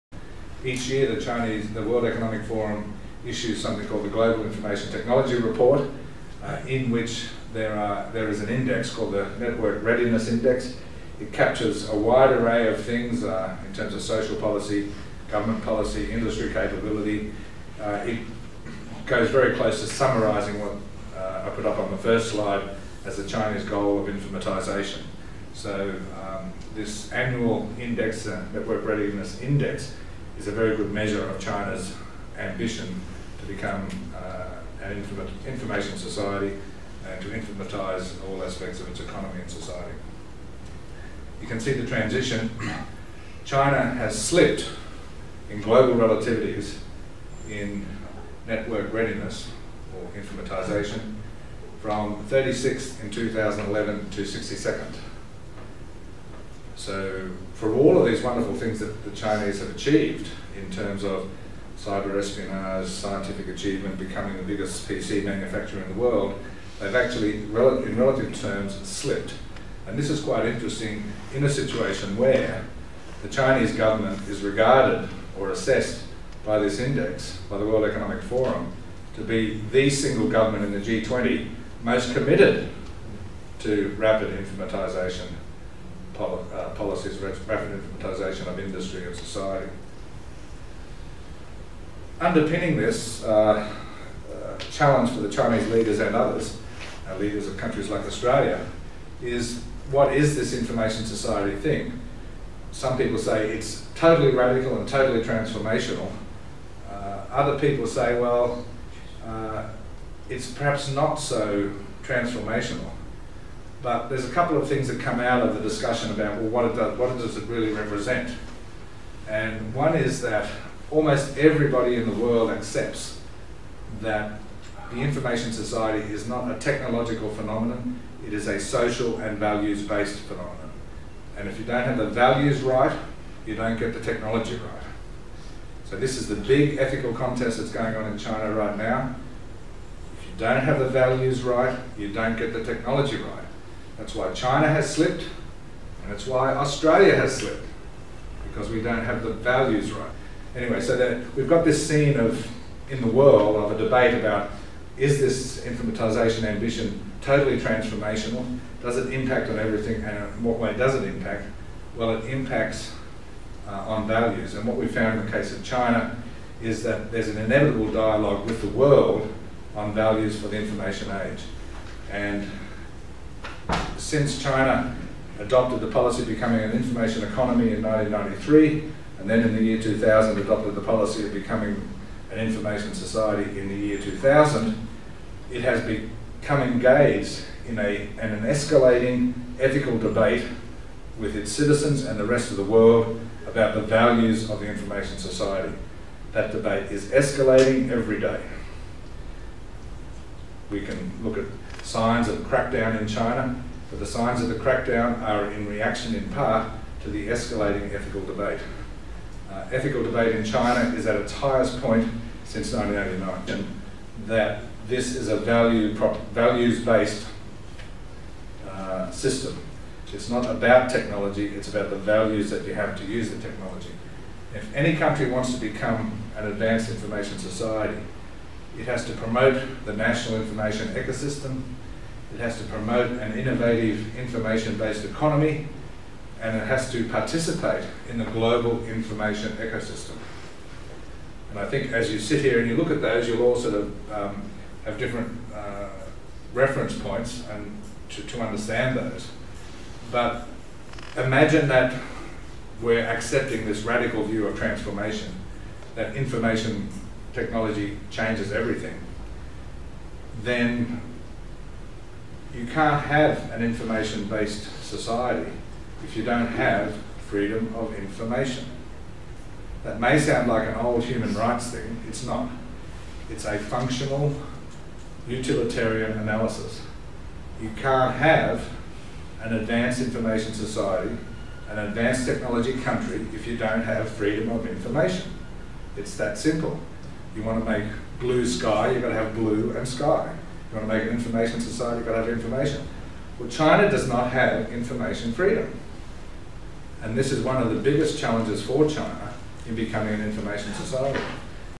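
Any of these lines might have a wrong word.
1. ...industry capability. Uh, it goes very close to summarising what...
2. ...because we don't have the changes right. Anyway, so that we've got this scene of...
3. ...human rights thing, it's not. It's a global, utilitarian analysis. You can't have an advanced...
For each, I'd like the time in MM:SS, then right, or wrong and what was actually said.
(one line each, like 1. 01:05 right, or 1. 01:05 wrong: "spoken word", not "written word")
1. 00:16 right
2. 02:28 wrong: "values", not "changes"
3. 04:31 wrong: "functional", not "global".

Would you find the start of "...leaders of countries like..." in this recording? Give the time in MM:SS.
01:37.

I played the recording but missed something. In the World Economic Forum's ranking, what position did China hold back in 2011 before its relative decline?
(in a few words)
36th.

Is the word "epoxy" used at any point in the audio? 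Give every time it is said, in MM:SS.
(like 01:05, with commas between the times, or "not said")
not said.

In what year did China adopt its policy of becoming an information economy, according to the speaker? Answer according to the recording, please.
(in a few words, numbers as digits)
1993.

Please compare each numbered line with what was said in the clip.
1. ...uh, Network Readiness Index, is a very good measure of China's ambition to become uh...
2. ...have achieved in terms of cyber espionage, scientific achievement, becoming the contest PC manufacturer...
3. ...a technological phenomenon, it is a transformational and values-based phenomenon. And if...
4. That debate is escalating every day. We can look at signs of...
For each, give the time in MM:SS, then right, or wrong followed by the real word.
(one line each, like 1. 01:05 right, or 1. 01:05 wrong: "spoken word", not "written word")
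1. 00:28 right
2. 00:59 wrong: "biggest", not "contest"
3. 02:06 wrong: "social", not "transformational"
4. 03:16 right.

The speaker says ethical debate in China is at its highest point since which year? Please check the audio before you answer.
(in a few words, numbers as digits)
1989.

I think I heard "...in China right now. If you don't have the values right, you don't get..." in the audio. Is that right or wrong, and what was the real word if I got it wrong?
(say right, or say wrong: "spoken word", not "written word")
right.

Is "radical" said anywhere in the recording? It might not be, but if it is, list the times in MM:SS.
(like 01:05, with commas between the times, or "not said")
01:44, 04:13.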